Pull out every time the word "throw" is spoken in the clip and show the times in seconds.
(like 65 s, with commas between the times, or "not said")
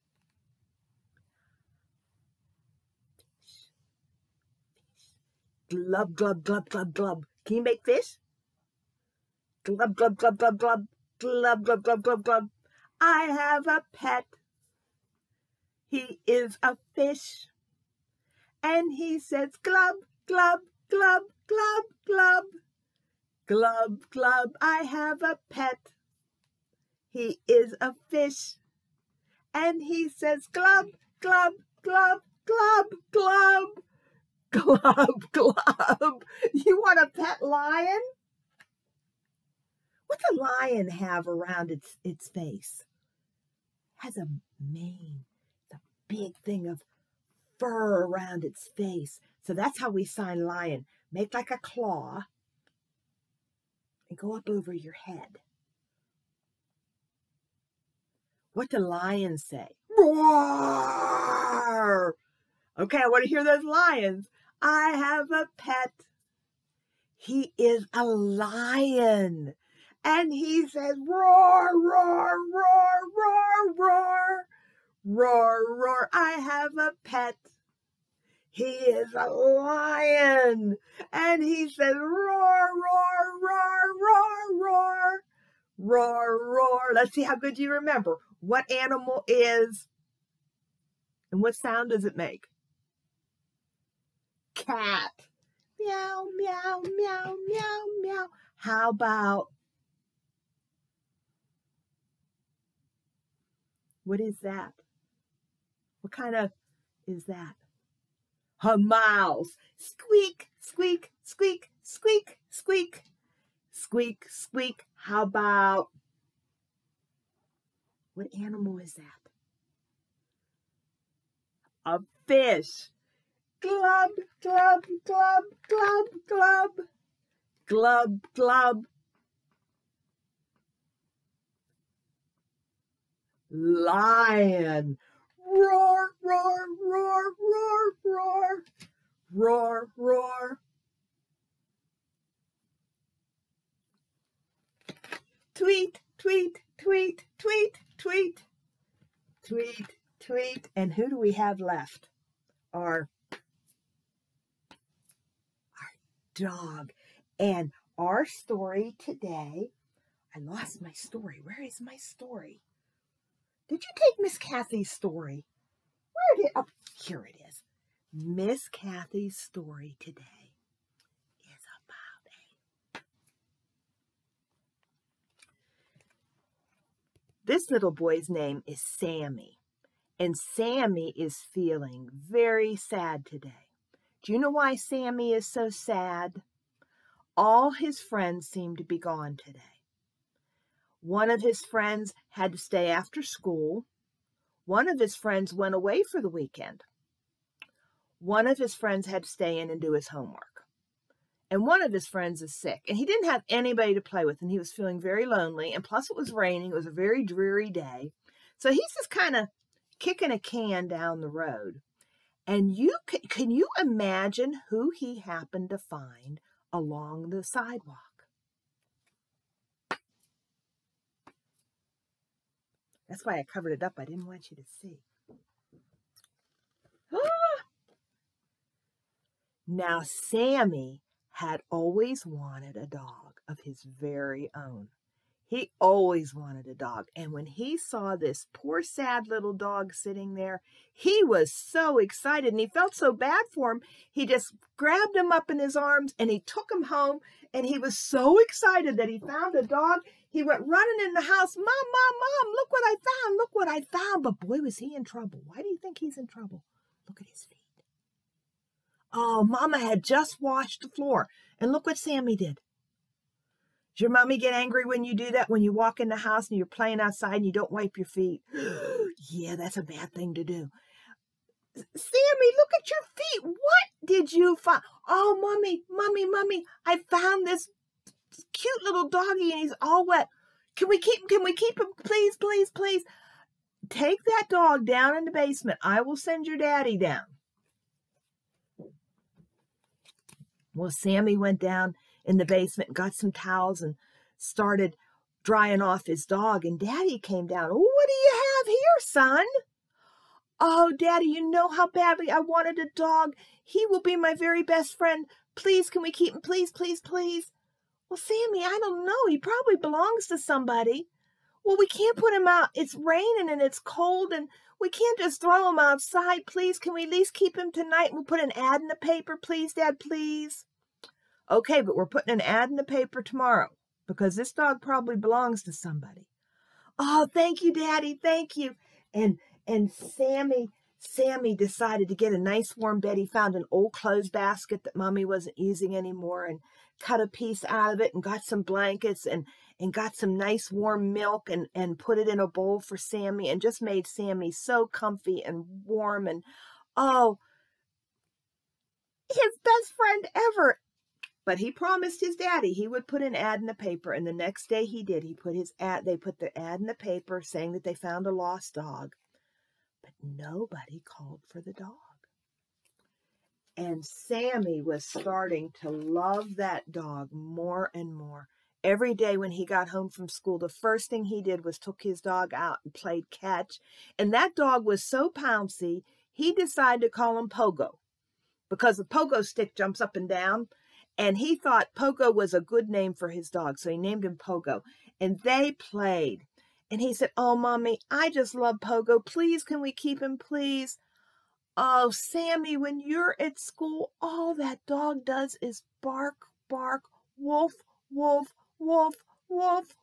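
315 s.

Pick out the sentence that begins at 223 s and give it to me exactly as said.
That's why I covered it up.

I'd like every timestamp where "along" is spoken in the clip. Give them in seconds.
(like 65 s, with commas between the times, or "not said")
216 s.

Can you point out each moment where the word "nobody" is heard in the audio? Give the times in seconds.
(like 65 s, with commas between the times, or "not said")
360 s.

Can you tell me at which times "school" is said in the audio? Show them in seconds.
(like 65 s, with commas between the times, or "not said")
193 s, 370 s, 393 s.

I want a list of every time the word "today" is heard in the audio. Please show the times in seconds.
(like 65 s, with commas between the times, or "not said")
158 s, 169 s, 183 s, 189 s.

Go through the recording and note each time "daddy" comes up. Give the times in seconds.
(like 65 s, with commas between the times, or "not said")
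286 s, 296 s, 300 s, 327 s, 352 s.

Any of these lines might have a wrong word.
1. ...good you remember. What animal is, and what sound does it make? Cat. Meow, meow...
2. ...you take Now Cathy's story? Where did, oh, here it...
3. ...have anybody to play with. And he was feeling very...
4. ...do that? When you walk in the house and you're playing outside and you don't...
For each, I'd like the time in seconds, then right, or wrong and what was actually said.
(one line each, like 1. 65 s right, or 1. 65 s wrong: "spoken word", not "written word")
1. 87 s right
2. 163 s wrong: "Miss", not "Now"
3. 203 s right
4. 265 s right.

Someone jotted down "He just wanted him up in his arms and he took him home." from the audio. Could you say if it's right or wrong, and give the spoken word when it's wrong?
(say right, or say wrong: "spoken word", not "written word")
wrong: "grabbed", not "wanted".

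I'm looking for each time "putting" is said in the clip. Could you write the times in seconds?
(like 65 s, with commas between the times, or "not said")
322 s.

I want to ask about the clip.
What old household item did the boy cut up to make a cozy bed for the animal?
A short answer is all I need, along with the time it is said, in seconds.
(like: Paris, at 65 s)
Clothes basket, at 333 s.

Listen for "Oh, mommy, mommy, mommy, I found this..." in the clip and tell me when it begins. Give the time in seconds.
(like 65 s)
275 s.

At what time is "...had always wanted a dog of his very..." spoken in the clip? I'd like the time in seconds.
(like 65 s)
231 s.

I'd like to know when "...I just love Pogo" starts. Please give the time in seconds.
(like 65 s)
388 s.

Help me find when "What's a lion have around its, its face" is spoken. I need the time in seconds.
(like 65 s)
40 s.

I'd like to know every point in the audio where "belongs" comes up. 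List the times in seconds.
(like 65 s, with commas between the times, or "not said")
309 s, 325 s.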